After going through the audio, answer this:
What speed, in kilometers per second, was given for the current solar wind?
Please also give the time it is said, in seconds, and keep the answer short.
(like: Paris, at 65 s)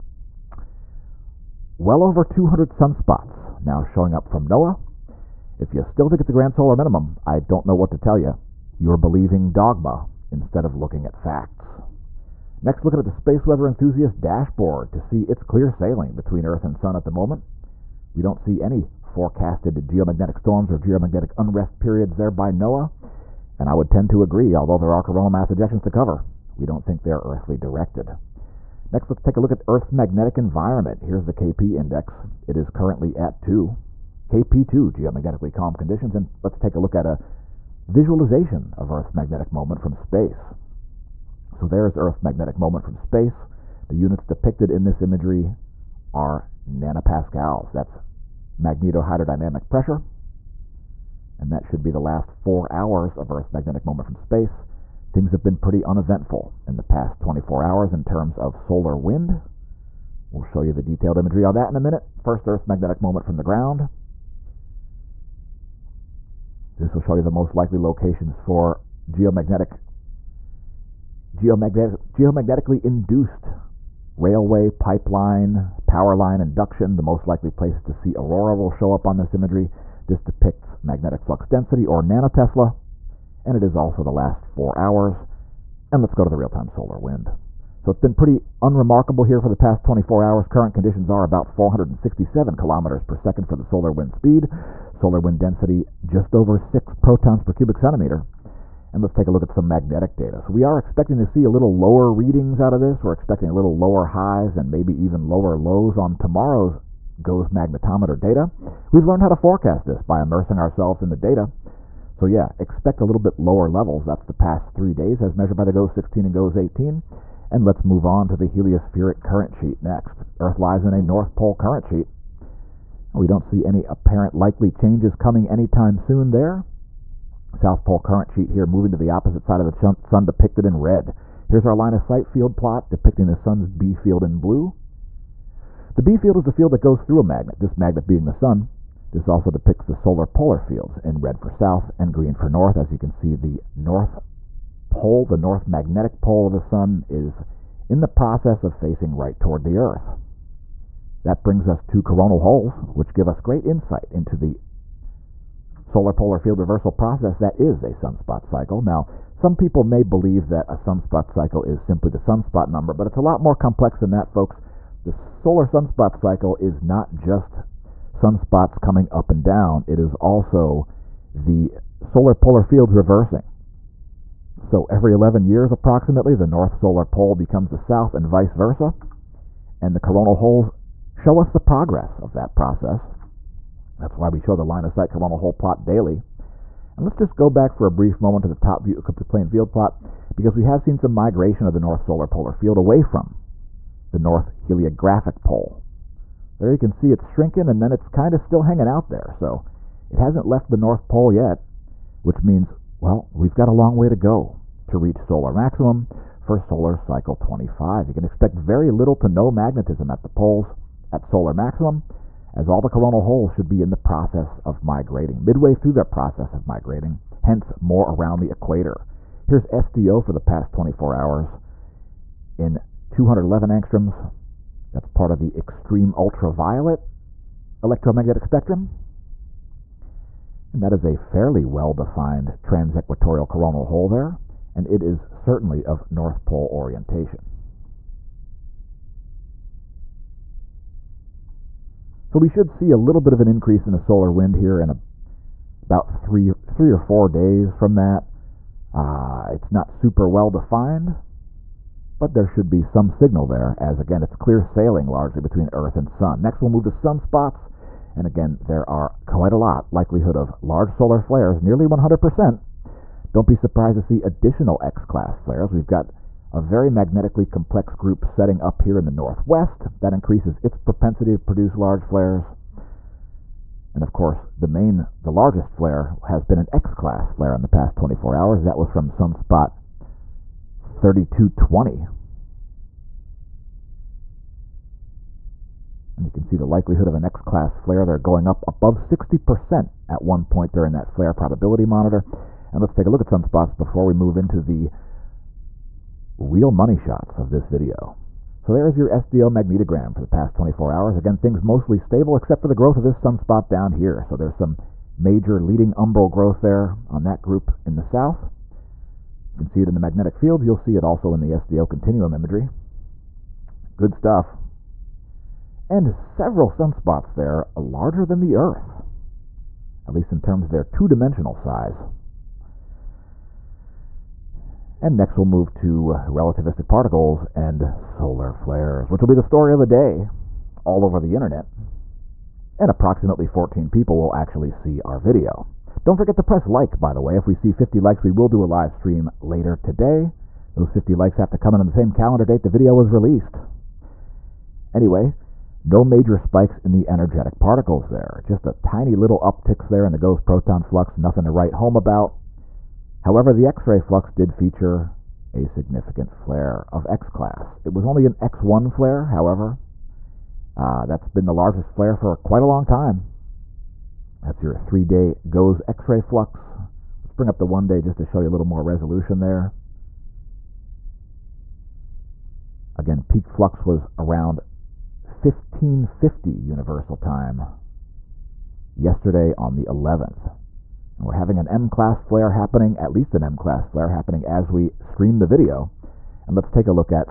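467, at 91 s.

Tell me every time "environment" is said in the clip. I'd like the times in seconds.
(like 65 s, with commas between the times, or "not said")
30 s.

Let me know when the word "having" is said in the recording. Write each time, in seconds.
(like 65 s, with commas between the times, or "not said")
381 s.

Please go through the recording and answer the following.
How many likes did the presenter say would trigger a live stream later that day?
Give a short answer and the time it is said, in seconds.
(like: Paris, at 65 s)
50, at 337 s.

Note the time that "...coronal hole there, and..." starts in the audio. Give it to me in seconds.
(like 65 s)
233 s.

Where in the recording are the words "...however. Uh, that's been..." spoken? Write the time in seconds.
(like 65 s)
359 s.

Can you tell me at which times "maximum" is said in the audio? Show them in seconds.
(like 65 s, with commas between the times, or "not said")
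205 s, 211 s.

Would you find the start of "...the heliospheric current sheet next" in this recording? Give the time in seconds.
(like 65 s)
118 s.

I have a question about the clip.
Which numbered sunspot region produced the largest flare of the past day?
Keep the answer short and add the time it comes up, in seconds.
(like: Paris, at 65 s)
3220, at 279 s.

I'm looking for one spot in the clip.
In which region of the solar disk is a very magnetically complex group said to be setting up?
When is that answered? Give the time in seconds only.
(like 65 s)
268 s.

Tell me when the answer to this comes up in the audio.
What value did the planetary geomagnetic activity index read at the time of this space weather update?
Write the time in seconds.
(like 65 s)
32 s.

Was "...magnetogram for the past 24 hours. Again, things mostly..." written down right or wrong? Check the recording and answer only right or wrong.
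right.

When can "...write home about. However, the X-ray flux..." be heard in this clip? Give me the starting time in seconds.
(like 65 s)
351 s.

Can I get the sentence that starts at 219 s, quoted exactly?
Here's SDO for the past 24 hours in 211 angstroms, that's part of the extreme ultraviolet electromagnetic spectrum.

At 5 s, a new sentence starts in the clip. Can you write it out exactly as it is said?
If you still think it's a grand solar minimum, I don't know what to tell you.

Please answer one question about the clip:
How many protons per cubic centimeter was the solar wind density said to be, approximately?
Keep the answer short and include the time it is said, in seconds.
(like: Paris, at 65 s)
just over 6, at 96 s.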